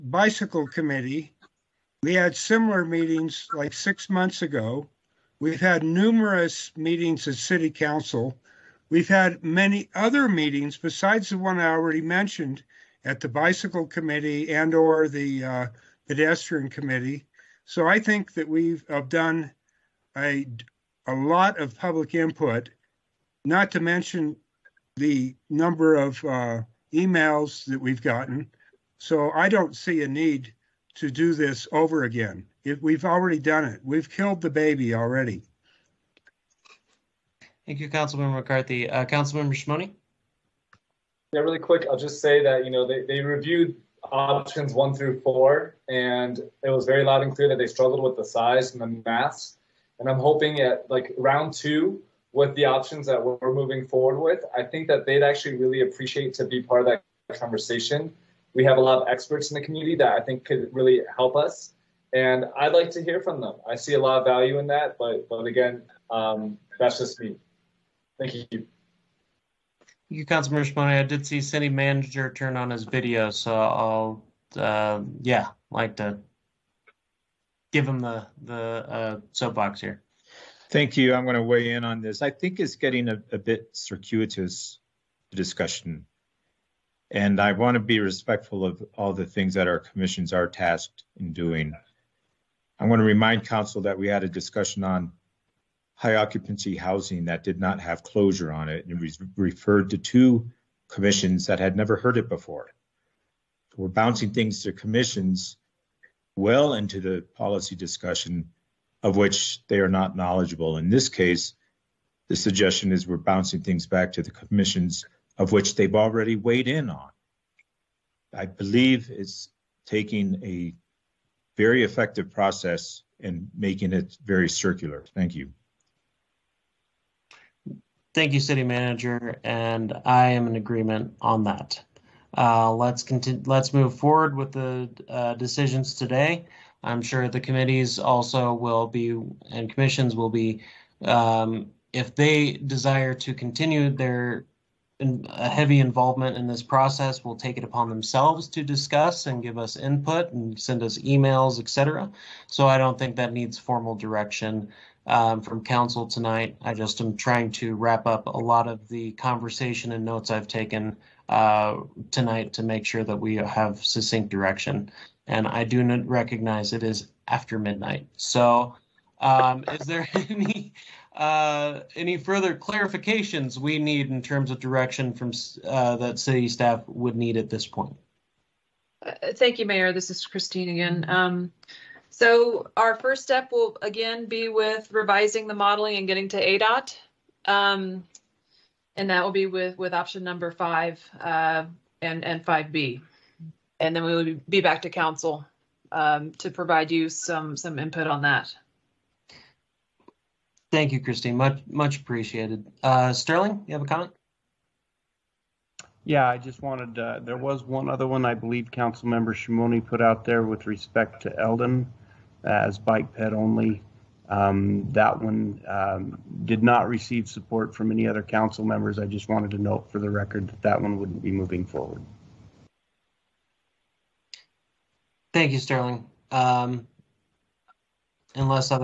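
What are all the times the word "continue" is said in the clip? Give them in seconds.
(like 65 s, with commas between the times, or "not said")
133 s, 143 s.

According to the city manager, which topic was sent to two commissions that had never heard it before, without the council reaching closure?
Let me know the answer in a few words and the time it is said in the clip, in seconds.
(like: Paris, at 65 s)
High occupancy housing, at 95 s.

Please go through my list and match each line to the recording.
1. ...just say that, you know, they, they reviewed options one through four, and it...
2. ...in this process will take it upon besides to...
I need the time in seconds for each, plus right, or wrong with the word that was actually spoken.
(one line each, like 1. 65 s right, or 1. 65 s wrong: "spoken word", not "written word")
1. 41 s right
2. 146 s wrong: "themselves", not "besides".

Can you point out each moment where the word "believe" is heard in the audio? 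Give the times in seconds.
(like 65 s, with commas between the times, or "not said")
118 s, 208 s.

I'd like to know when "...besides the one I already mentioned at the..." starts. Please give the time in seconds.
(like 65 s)
10 s.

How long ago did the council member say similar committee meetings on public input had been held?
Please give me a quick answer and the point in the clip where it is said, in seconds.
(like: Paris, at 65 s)
6 months ago, at 3 s.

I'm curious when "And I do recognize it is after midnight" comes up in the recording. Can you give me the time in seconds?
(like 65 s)
165 s.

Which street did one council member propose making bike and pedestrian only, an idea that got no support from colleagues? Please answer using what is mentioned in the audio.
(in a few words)
Elden.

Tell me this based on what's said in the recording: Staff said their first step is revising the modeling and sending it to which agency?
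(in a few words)
ADOT.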